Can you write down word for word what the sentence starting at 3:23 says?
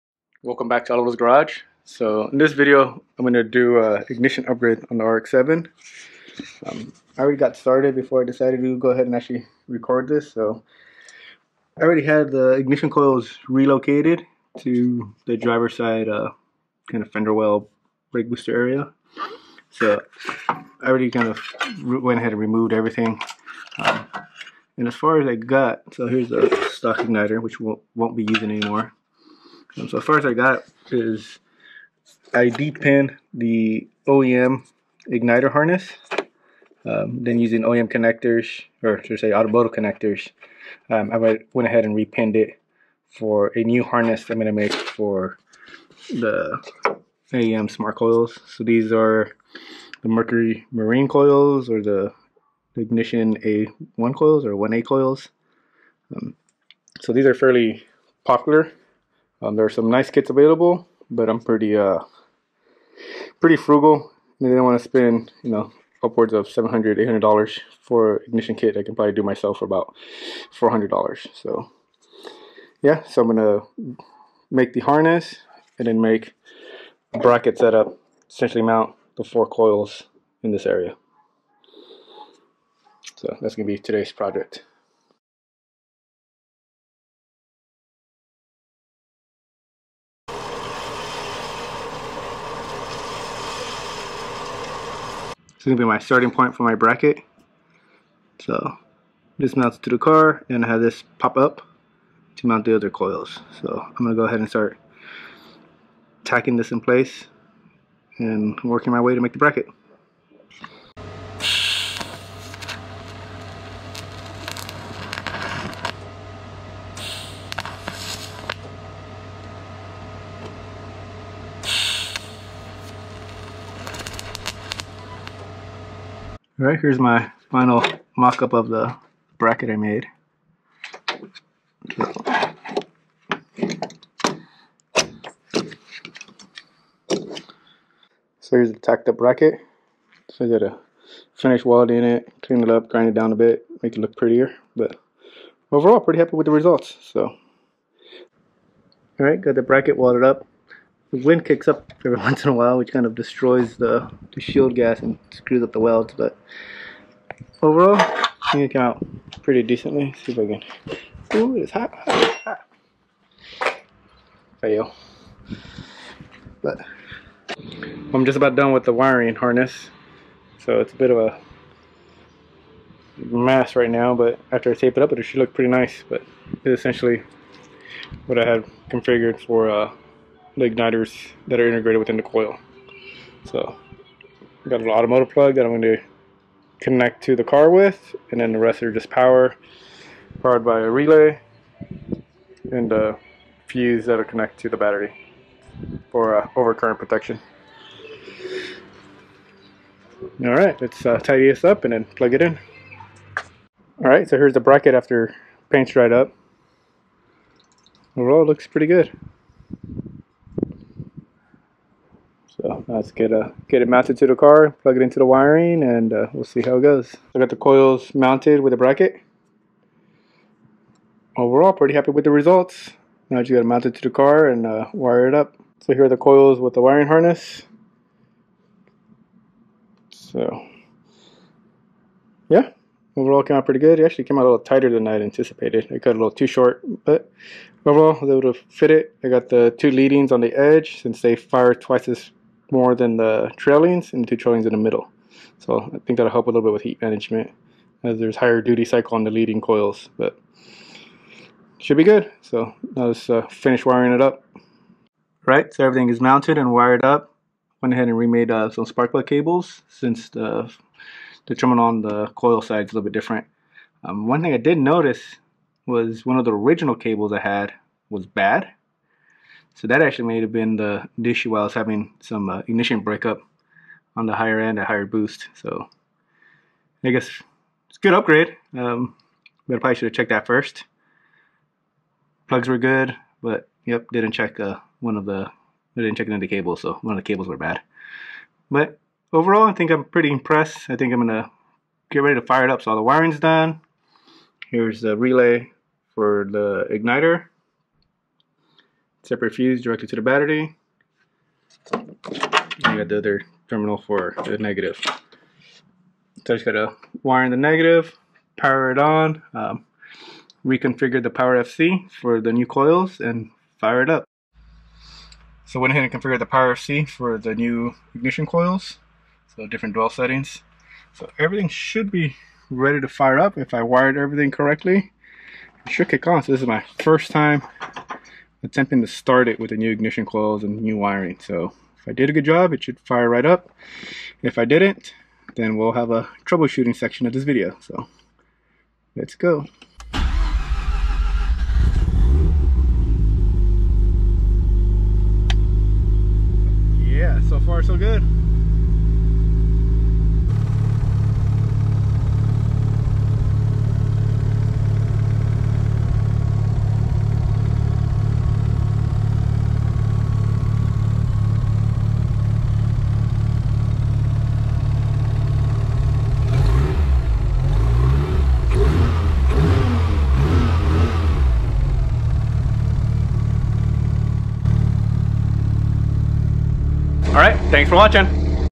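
Alright, so here's the bracket after paint's dried up.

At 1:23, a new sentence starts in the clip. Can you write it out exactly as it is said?
So that's going to be today's project.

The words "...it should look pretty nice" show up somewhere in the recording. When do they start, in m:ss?
2:55.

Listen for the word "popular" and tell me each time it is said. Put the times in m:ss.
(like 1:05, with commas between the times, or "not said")
0:58.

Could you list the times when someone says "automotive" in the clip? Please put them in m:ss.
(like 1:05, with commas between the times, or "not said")
0:39, 3:04.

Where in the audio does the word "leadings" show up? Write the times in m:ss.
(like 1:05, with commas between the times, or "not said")
3:59, 4:09.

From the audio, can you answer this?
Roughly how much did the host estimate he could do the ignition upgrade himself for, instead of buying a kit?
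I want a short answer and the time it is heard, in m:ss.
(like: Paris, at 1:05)
$400, at 1:09.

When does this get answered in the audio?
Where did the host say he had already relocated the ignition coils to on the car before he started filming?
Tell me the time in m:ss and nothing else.
0:15.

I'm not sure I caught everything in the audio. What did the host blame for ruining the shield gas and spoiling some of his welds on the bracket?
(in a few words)
The wind.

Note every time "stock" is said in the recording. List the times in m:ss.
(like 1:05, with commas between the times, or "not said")
0:26.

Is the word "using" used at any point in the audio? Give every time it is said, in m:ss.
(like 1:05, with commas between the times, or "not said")
0:28, 0:37.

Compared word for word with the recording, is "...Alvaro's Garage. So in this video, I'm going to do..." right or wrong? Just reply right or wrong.
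right.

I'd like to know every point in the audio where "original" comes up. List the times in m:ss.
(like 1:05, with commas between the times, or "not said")
4:26.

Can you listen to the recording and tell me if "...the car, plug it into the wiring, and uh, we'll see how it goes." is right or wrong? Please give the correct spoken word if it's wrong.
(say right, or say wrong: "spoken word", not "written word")
right.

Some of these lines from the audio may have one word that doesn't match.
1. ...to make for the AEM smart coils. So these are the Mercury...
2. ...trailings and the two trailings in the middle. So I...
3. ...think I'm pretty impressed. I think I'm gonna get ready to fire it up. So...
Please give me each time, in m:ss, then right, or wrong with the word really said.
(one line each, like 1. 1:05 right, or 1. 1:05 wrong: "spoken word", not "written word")
1. 0:44 right
2. 4:03 right
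3. 4:49 right.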